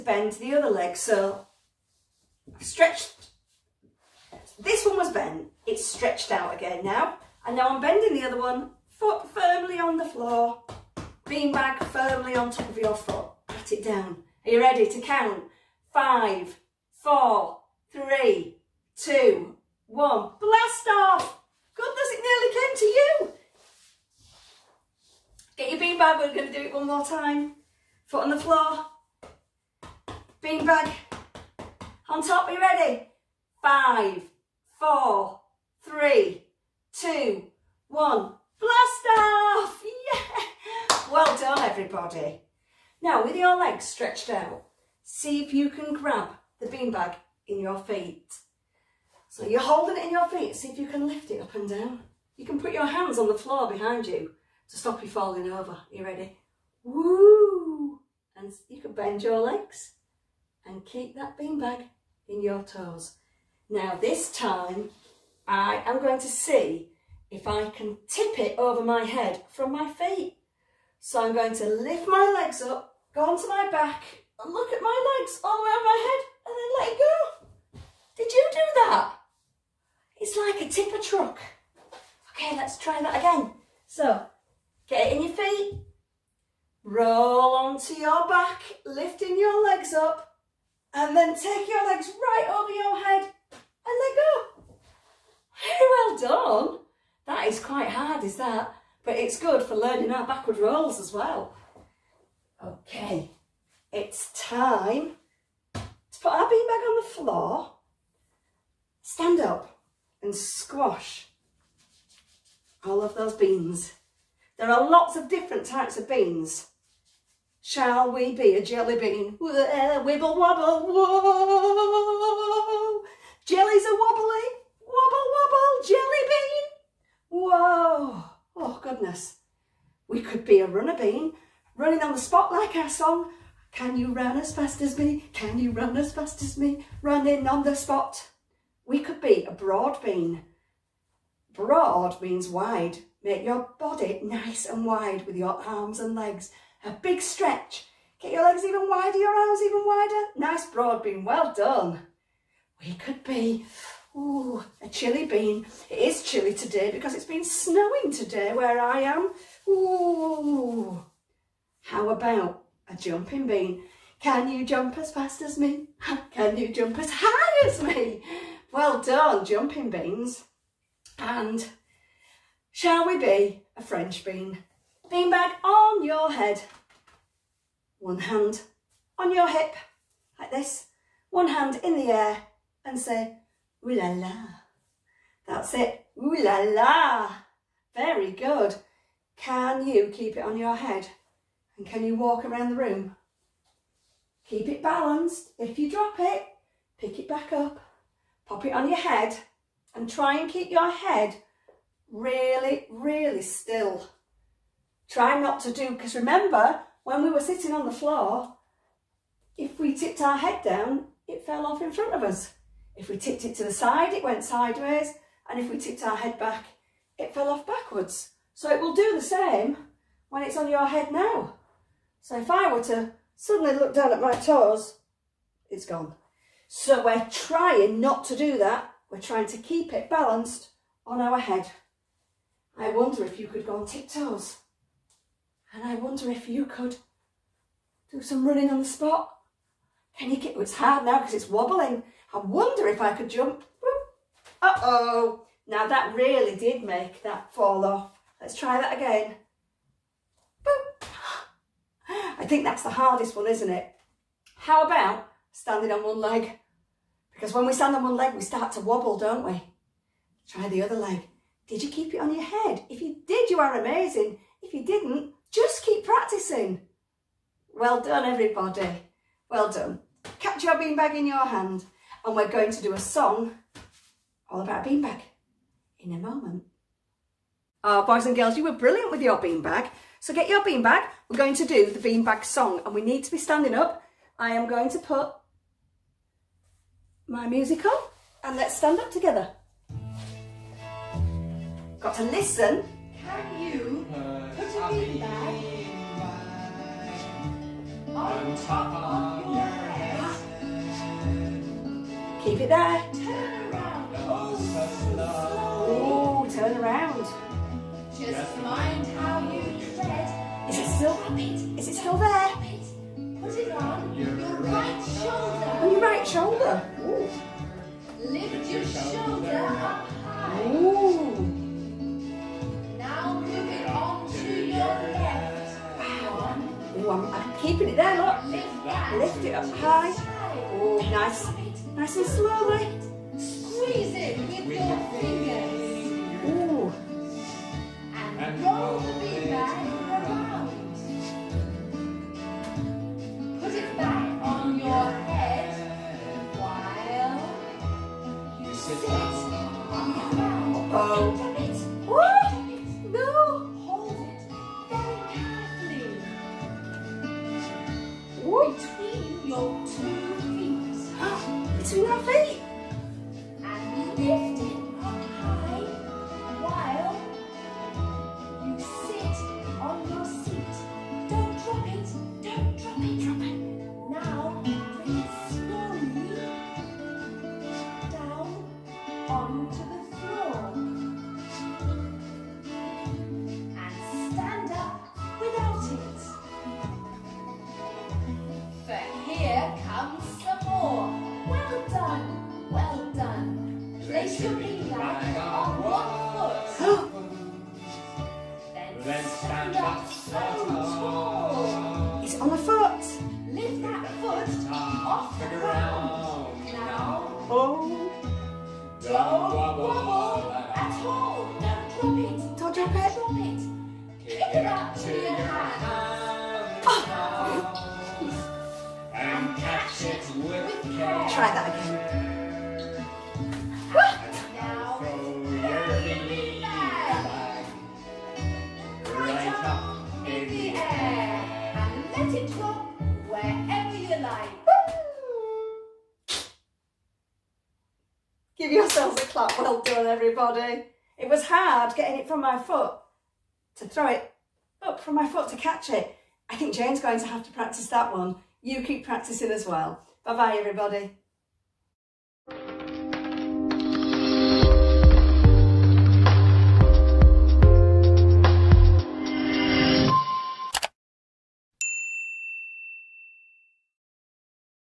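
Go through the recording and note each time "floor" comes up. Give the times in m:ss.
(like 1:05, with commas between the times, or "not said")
0:10, 0:28, 0:53, 1:47, 3:27.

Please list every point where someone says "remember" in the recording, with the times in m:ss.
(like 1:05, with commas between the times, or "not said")
3:26.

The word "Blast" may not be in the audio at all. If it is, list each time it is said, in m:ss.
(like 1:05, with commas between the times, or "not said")
0:20, 0:38.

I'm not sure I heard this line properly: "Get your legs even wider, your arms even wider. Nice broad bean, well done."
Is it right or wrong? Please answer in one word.
right.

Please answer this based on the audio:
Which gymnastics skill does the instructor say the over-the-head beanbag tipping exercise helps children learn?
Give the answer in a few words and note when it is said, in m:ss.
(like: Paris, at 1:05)
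backward rolls, at 1:40.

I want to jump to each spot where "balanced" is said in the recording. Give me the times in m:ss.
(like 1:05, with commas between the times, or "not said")
3:14, 3:50.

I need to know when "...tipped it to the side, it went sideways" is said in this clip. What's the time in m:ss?
3:33.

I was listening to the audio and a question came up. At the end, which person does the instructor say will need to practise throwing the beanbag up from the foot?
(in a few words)
Jane.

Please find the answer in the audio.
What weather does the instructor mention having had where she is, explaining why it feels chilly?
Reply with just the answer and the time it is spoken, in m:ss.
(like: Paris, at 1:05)
snowing, at 2:37.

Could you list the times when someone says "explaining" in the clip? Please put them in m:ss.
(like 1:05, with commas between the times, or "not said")
not said.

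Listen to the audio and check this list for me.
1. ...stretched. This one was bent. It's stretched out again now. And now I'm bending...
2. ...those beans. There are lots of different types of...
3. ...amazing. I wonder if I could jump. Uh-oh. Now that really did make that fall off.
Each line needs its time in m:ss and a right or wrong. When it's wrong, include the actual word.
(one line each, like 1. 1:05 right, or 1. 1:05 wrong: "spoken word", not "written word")
1. 0:02 right
2. 1:53 right
3. 4:01 wrong: "wobbling", not "amazing".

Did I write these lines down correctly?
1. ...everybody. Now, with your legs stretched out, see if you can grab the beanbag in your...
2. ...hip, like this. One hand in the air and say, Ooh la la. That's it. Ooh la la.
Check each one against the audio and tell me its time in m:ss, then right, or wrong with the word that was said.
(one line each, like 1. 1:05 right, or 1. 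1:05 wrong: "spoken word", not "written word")
1. 0:41 right
2. 2:59 right.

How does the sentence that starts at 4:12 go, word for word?
I think that's the hardest one, isn't it?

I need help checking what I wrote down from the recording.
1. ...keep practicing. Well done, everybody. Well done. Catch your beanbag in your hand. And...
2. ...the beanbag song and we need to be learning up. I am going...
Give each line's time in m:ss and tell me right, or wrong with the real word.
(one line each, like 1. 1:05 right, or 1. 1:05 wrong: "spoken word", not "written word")
1. 4:25 right
2. 4:41 wrong: "standing", not "learning".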